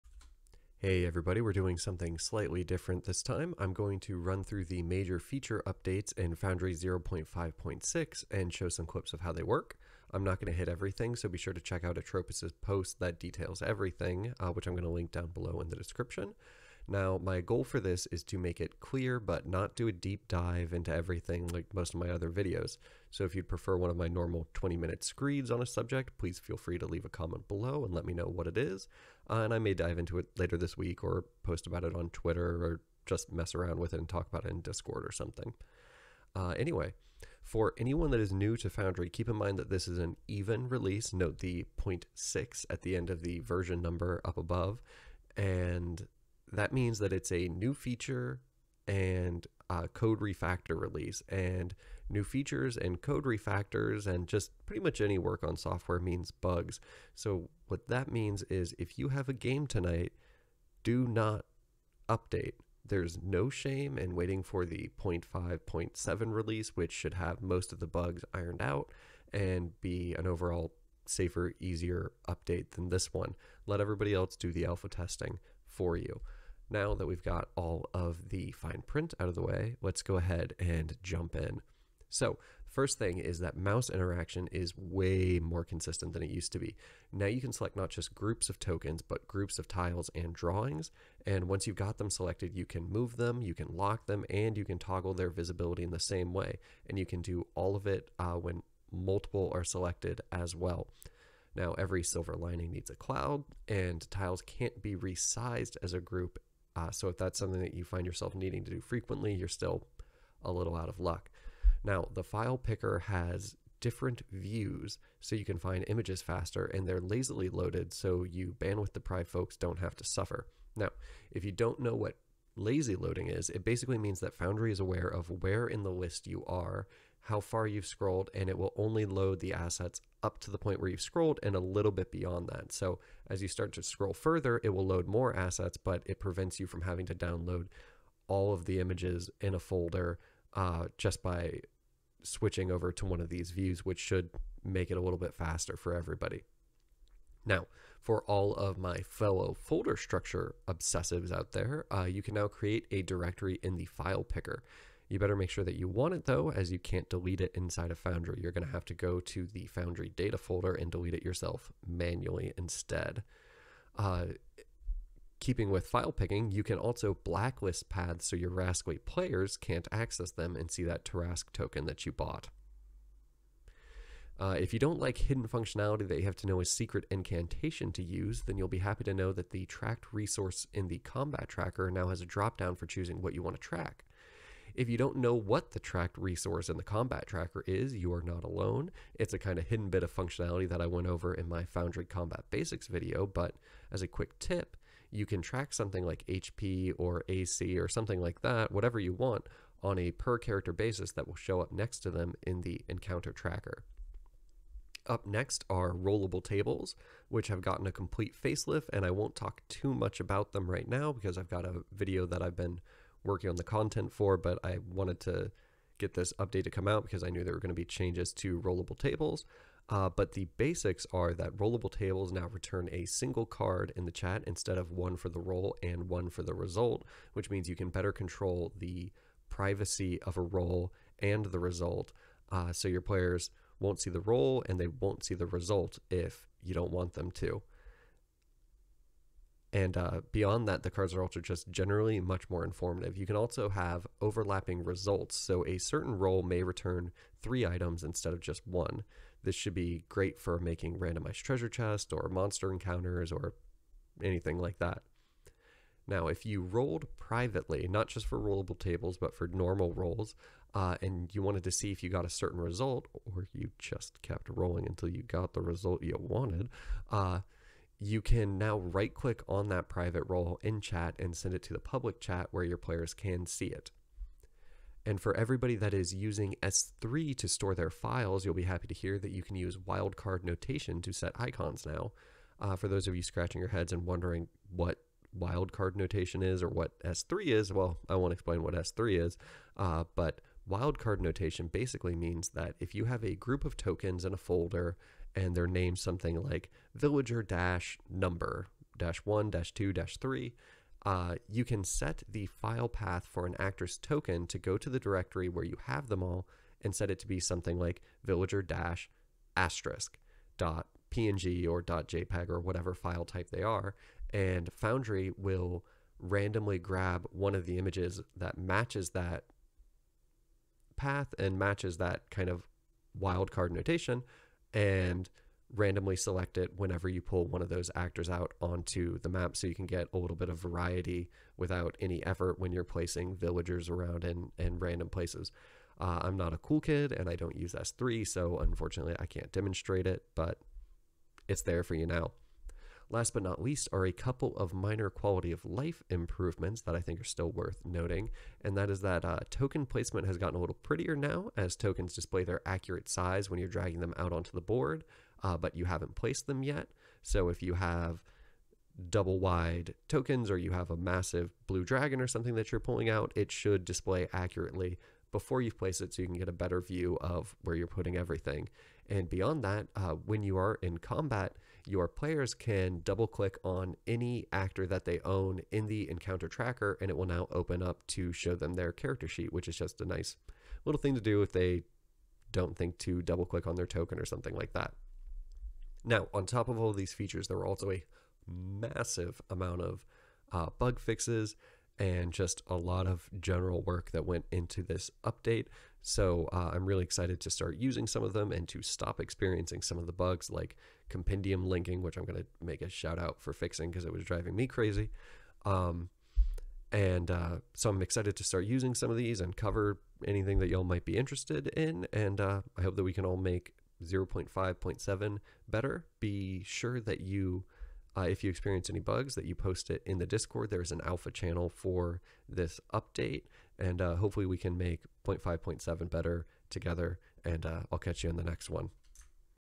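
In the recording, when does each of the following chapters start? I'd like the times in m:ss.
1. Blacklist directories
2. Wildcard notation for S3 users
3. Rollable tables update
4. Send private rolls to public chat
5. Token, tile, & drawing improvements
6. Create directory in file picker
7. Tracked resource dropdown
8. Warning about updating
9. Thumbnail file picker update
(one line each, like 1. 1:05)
1. 2:45
2. 4:35
3. 3:26
4. 4:15
5. 1:23
6. 2:29
7. 2:58
8. 0:37
9. 1:51.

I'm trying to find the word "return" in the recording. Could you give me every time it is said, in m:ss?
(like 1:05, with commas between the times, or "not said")
3:42, 4:06.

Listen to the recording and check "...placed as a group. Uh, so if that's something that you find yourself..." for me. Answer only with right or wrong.
wrong.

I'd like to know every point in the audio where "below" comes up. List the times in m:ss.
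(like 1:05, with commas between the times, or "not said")
0:15, 0:27.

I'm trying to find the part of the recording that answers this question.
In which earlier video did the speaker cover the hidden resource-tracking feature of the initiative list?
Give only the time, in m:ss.
3:11.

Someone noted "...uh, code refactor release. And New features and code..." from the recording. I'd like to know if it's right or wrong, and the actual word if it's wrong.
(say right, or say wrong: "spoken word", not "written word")
right.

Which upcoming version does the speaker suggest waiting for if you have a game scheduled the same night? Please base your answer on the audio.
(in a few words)
0.5.7.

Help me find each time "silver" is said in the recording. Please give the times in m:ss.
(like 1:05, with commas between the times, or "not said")
1:42.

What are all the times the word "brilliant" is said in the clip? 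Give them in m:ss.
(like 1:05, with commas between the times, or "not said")
not said.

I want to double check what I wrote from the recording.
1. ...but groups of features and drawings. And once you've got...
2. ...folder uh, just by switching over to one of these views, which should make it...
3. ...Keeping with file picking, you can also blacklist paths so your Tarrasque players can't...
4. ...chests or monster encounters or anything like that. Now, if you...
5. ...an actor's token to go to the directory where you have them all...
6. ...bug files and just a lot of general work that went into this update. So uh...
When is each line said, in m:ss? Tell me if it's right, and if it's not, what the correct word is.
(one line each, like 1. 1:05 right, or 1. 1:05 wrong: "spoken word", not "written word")
1. 1:29 wrong: "tiles", not "features"
2. 2:19 right
3. 2:45 wrong: "Rascally", not "Tarrasque"
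4. 4:11 right
5. 5:03 right
6. 6:30 wrong: "fixes", not "files".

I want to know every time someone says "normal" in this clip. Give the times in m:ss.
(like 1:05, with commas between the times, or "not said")
0:24, 4:19.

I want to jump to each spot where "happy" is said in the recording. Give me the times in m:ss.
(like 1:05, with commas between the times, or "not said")
2:58, 4:38.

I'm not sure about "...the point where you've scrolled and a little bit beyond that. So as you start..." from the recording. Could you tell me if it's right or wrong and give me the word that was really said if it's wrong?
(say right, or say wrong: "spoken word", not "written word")
right.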